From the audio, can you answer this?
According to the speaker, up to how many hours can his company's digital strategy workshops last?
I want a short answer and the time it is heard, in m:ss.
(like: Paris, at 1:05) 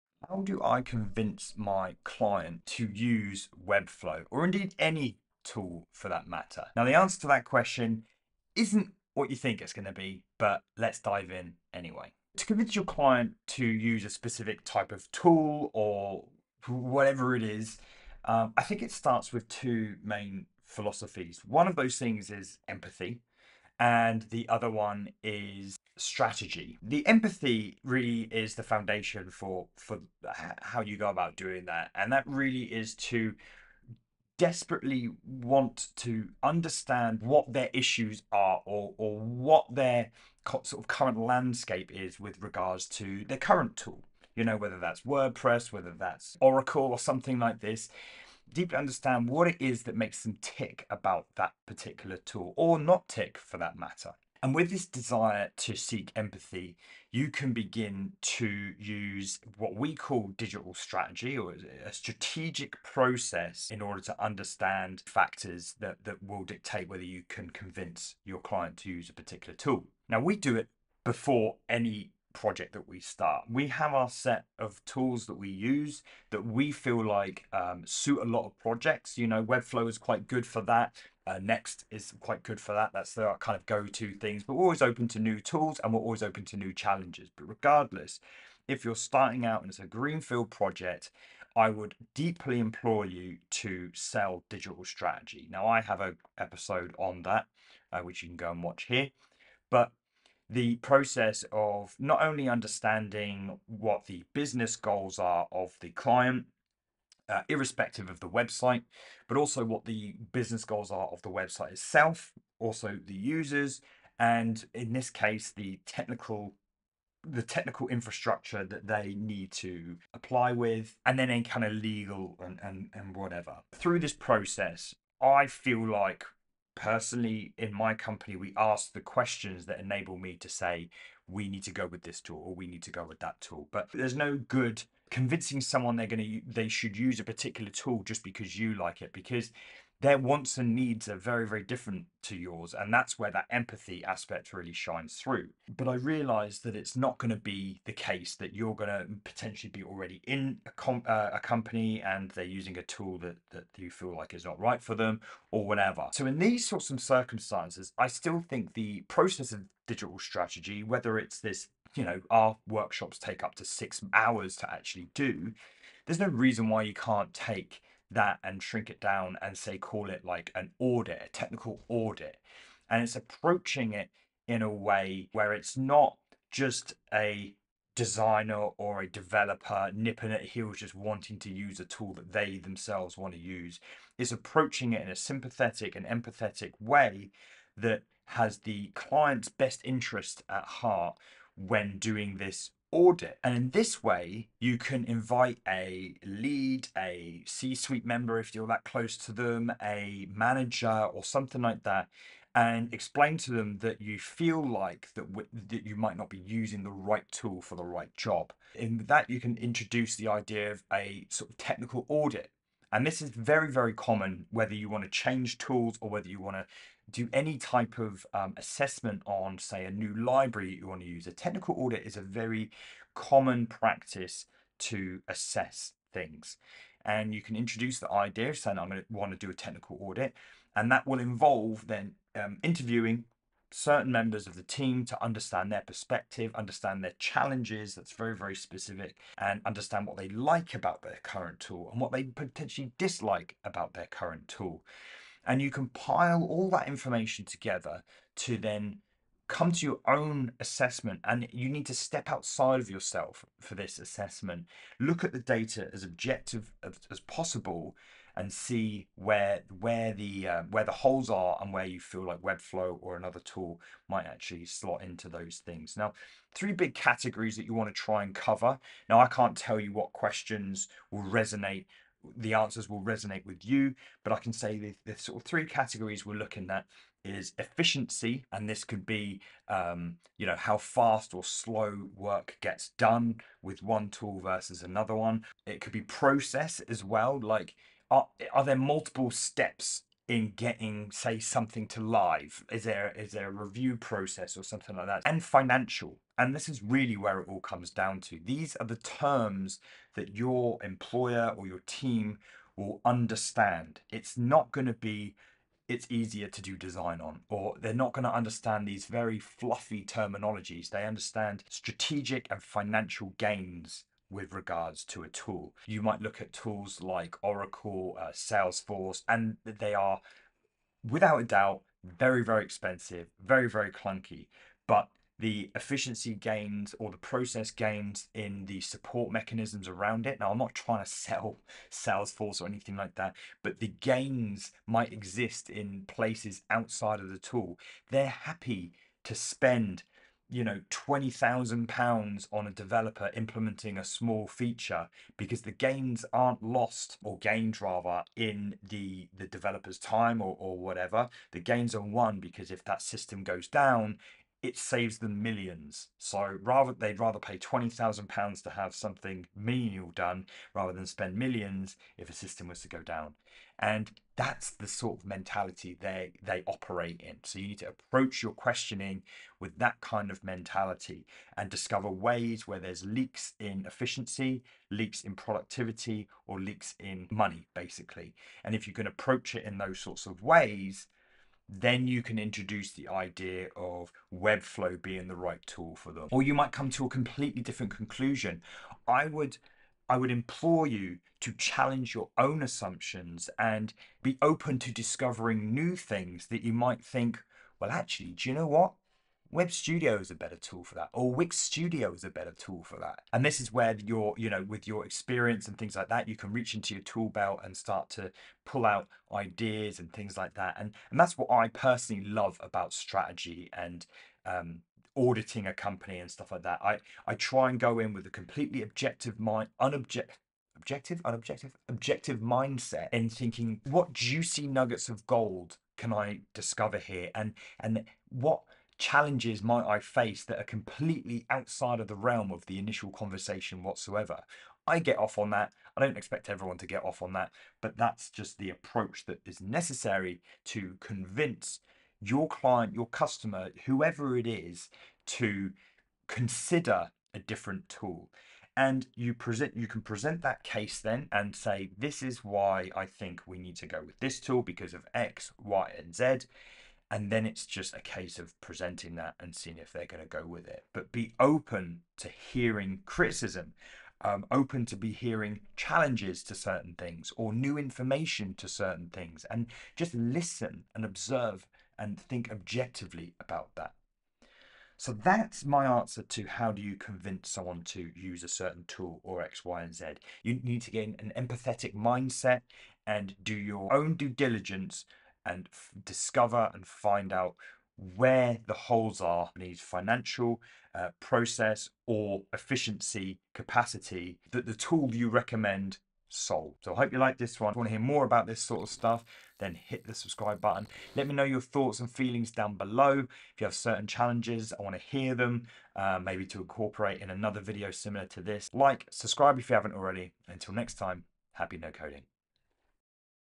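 6 hours, at 2:43.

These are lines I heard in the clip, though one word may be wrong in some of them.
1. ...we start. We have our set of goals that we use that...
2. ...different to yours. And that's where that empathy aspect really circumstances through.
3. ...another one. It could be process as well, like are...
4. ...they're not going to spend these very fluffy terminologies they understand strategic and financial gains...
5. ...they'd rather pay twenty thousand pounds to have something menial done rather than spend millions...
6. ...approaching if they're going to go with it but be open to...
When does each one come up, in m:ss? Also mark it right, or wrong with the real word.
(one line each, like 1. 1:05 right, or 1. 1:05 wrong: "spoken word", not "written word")
1. 1:12 wrong: "tools", not "goals"
2. 2:21 wrong: "shines", not "circumstances"
3. 4:44 right
4. 5:07 wrong: "understand", not "spend"
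5. 5:56 right
6. 7:39 wrong: "seeing", not "approaching".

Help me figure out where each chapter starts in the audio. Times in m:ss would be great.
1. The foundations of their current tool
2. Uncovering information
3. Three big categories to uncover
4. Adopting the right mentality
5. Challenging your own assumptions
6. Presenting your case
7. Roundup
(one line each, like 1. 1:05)
1. 0:16
2. 0:54
3. 4:26
4. 5:15
5. 6:29
6. 7:28
7. 7:54.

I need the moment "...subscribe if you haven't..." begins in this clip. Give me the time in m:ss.
8:29.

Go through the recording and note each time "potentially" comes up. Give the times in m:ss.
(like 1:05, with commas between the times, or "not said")
2:29, 4:02.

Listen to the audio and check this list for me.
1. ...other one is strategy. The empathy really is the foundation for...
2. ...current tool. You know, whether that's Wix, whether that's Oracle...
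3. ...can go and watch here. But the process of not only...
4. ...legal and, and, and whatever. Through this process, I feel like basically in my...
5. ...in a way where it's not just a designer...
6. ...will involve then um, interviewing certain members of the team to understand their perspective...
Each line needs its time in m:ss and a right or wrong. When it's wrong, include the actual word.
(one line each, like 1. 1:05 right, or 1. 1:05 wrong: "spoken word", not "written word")
1. 0:24 right
2. 0:43 wrong: "WordPress", not "Wix"
3. 1:38 right
4. 2:01 wrong: "personally", not "basically"
5. 2:54 right
6. 3:51 right.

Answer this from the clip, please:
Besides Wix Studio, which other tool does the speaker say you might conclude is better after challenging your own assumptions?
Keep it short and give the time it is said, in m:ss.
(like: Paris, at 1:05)
Web Studio, at 6:39.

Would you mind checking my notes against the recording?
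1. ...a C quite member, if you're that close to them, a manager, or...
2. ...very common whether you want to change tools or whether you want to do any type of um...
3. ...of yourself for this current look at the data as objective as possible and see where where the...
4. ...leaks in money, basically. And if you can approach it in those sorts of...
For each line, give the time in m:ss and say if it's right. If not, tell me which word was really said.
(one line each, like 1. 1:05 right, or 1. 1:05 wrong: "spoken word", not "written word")
1. 3:16 wrong: "suite", not "quite"
2. 3:33 right
3. 4:12 wrong: "assessment", not "current"
4. 6:16 right.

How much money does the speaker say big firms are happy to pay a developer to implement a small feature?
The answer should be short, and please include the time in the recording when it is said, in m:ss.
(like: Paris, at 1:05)
£20,000, at 5:40.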